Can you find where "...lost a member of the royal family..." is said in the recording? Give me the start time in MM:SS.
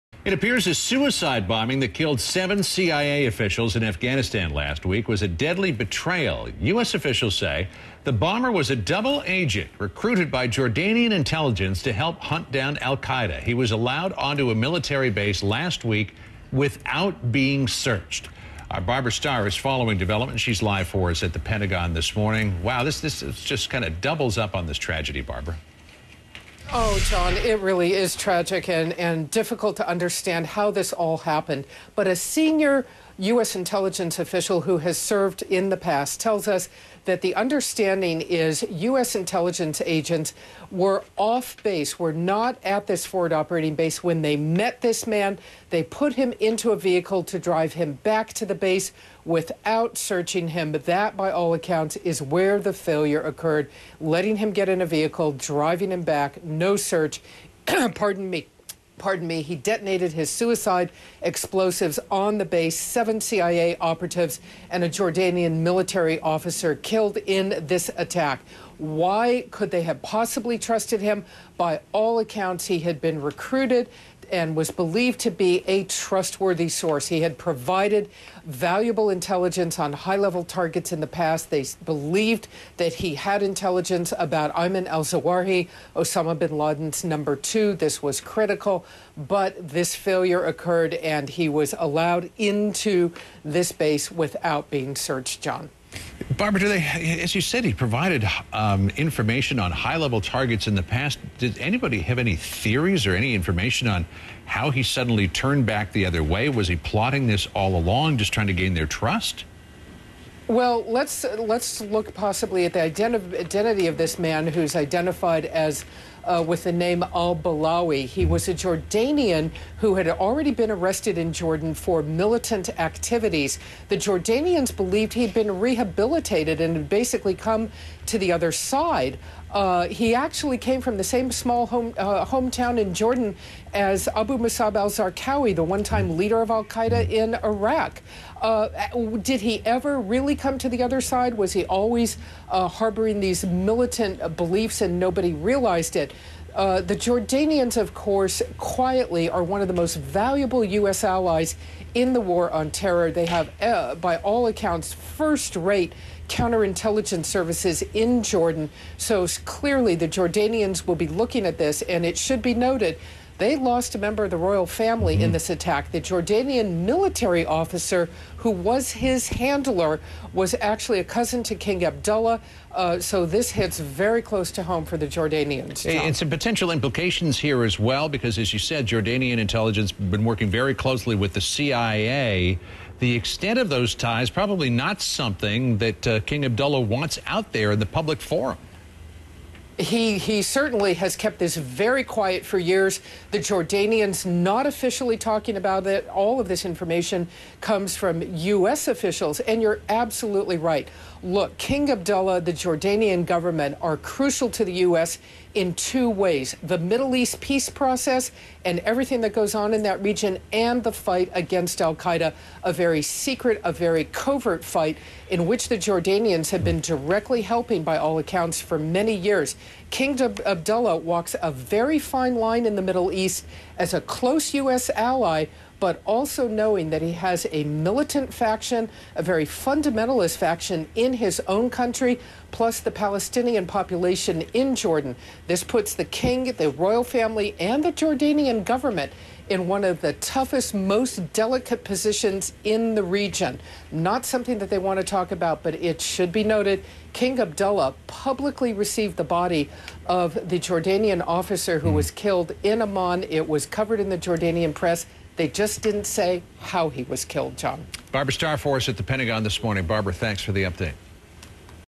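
02:43.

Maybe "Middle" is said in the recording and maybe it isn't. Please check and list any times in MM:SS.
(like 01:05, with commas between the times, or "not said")
03:26, 03:42.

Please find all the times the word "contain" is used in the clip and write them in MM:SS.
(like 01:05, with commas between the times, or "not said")
not said.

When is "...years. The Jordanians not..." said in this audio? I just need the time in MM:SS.
03:12.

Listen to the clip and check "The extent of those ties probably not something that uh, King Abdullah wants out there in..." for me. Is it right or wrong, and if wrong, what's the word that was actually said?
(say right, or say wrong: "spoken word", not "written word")
right.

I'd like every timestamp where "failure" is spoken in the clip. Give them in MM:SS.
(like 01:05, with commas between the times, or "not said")
00:52, 01:29.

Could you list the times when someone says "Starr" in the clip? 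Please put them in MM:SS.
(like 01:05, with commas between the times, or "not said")
00:19, 04:18.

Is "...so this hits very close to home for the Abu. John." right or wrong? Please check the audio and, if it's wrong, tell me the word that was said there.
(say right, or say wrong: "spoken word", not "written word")
wrong: "Jordanians", not "Abu".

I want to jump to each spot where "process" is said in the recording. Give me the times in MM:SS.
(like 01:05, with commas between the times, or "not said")
03:27.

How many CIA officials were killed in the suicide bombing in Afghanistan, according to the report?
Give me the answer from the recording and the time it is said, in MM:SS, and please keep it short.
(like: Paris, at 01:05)
7, at 00:02.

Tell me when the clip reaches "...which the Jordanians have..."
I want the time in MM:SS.
03:35.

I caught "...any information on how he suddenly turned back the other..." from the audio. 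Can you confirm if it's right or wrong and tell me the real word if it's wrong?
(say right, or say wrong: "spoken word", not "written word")
right.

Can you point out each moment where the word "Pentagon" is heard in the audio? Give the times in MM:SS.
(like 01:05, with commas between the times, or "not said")
00:21, 04:19.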